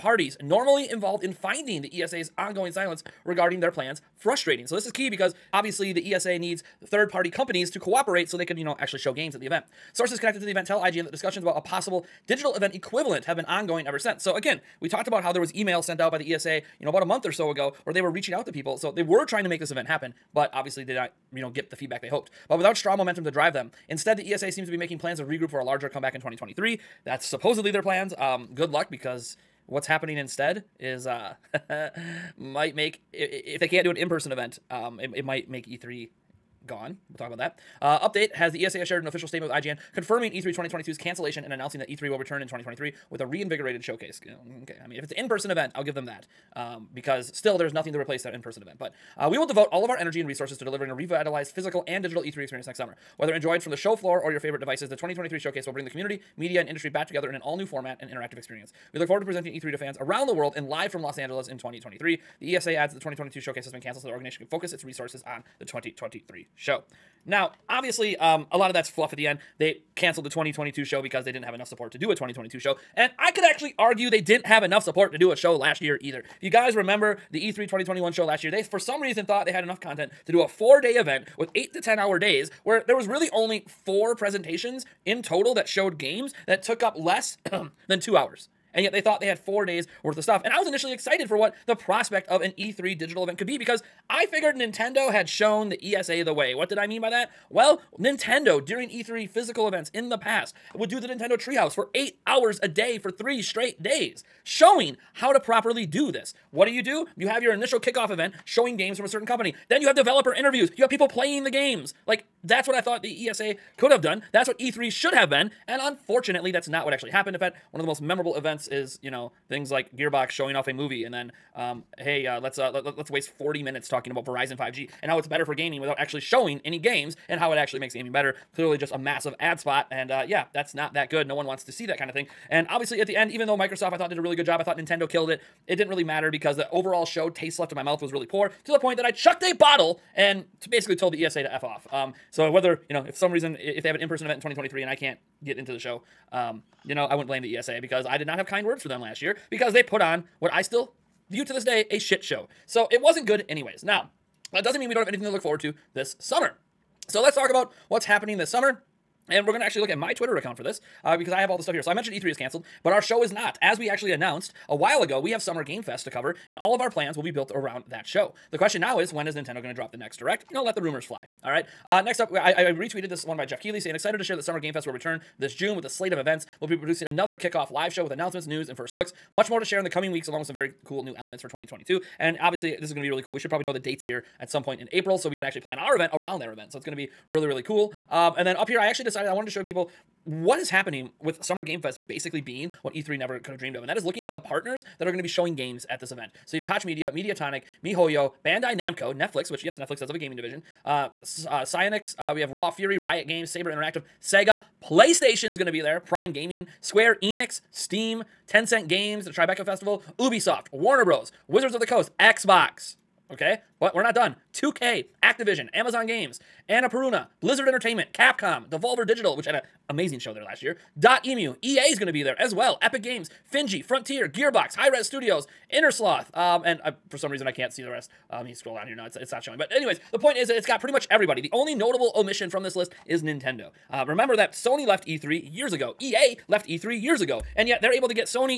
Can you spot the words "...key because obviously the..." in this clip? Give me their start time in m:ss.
0:04.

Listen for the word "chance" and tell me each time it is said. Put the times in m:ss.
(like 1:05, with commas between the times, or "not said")
not said.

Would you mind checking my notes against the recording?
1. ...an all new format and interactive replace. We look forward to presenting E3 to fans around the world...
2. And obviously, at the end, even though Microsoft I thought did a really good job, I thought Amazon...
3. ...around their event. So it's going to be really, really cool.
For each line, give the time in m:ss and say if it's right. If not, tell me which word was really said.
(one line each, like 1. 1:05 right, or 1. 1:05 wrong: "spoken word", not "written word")
1. 0:57 wrong: "experience", not "replace"
2. 2:12 wrong: "Nintendo", not "Amazon"
3. 3:06 right.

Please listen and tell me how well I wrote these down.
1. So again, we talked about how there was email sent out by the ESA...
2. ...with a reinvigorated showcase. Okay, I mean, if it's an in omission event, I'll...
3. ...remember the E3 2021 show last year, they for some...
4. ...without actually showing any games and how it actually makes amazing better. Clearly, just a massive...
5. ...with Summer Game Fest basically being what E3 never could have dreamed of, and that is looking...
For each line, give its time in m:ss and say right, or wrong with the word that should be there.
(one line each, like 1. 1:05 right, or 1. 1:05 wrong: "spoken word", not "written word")
1. 0:14 right
2. 0:43 wrong: "person", not "omission"
3. 1:16 right
4. 2:05 wrong: "gaming", not "amazing"
5. 3:11 right.